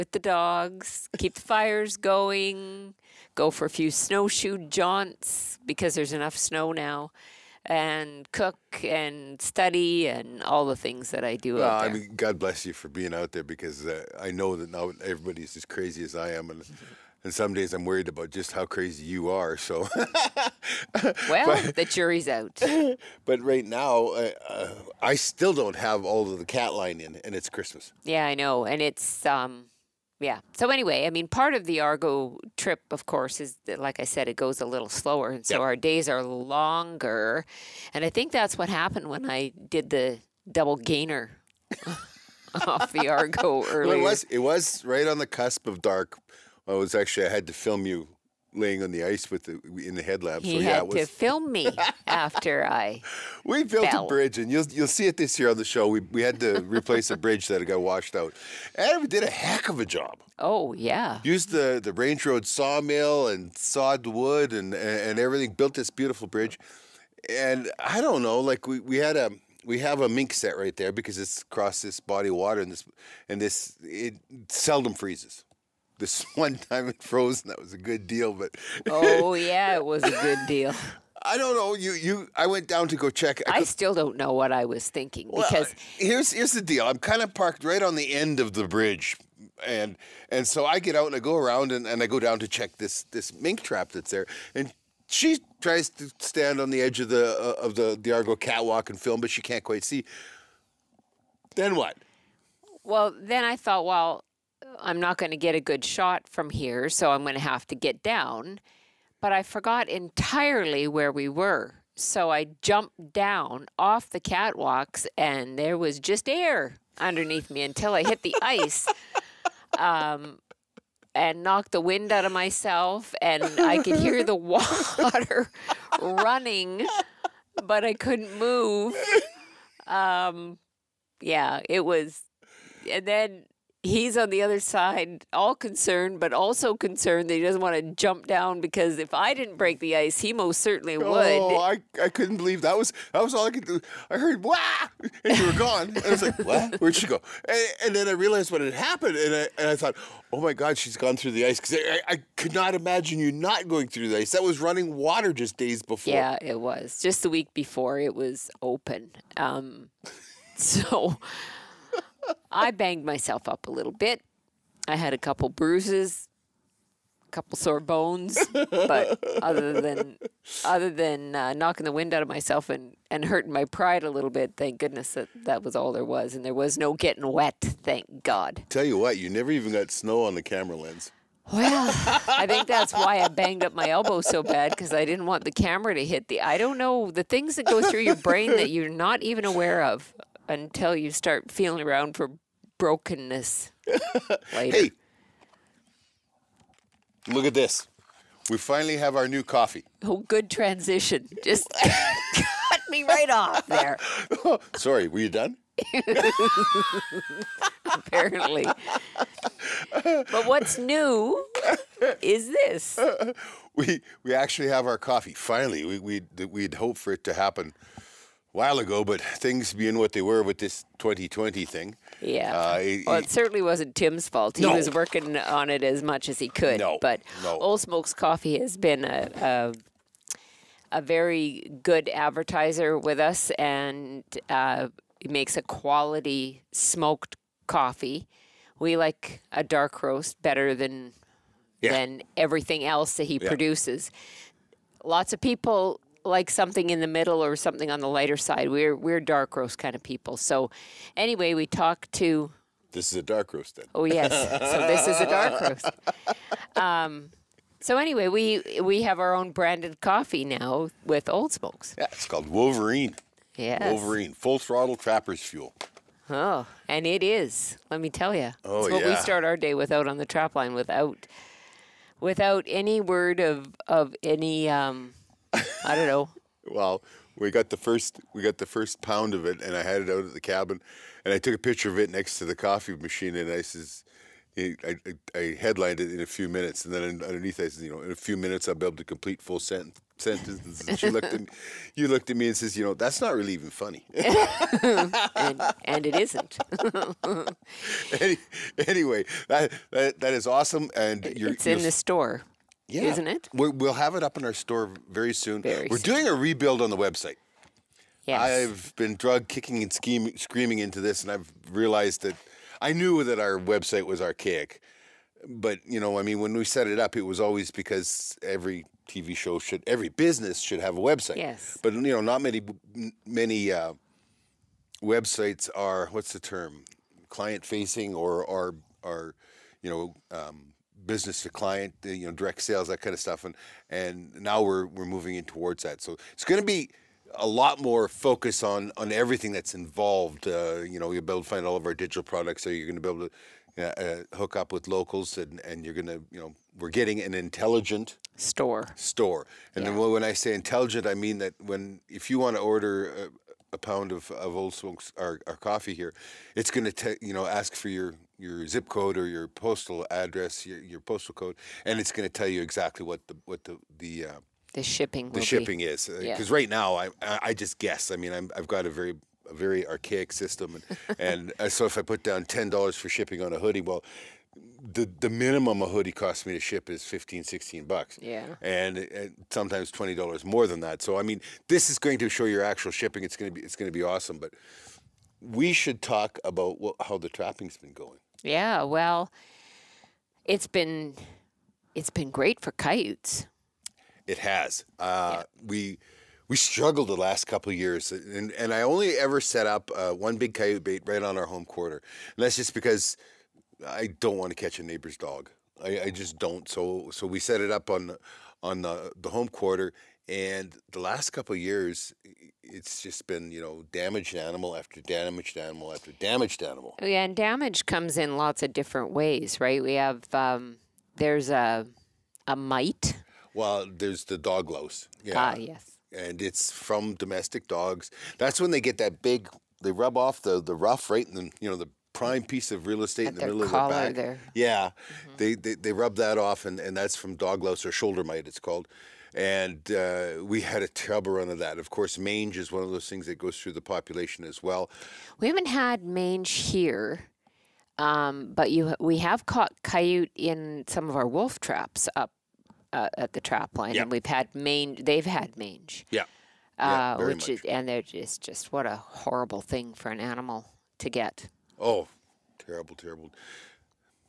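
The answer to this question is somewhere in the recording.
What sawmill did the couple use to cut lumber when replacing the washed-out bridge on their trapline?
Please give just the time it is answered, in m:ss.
1:01.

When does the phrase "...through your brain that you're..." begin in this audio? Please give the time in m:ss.
3:07.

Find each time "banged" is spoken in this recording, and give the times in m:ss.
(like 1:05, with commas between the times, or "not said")
2:42, 3:03.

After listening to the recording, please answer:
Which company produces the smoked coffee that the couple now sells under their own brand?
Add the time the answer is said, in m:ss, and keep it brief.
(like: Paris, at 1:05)
Old Smokes Coffee, at 3:47.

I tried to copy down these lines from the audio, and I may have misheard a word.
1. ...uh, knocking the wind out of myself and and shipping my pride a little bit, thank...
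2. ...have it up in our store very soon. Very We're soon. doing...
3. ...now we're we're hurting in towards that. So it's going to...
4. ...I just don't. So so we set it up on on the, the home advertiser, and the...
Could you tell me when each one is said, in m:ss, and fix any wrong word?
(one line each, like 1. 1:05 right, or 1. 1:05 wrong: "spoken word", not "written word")
1. 2:51 wrong: "hurting", not "shipping"
2. 5:03 right
3. 5:34 wrong: "moving", not "hurting"
4. 6:46 wrong: "quarter", not "advertiser".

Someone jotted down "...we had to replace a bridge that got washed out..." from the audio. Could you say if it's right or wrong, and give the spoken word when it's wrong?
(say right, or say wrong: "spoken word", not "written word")
right.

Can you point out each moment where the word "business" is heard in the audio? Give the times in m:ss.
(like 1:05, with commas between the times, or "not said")
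5:20, 5:31.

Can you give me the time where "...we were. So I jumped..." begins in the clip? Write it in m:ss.
1:51.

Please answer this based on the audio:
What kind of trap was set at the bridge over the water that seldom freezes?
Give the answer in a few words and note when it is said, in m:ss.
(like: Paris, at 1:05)
mink set, at 1:10.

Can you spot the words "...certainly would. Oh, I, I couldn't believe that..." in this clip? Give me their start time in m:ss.
2:20.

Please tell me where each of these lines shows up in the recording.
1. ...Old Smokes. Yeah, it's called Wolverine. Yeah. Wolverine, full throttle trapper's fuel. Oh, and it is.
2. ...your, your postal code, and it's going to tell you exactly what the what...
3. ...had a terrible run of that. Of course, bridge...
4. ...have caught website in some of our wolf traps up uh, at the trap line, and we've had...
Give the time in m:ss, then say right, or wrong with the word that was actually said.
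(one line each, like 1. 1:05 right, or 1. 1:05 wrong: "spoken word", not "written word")
1. 4:21 right
2. 6:00 right
3. 7:20 wrong: "mange", not "bridge"
4. 7:29 wrong: "coyote", not "website".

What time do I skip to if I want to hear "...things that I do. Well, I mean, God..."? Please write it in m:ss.
0:10.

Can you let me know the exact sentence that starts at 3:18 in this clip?
We finally have our new coffee.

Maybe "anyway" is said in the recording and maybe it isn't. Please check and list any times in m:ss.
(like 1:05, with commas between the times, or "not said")
0:30, 4:11, 4:17, 4:58.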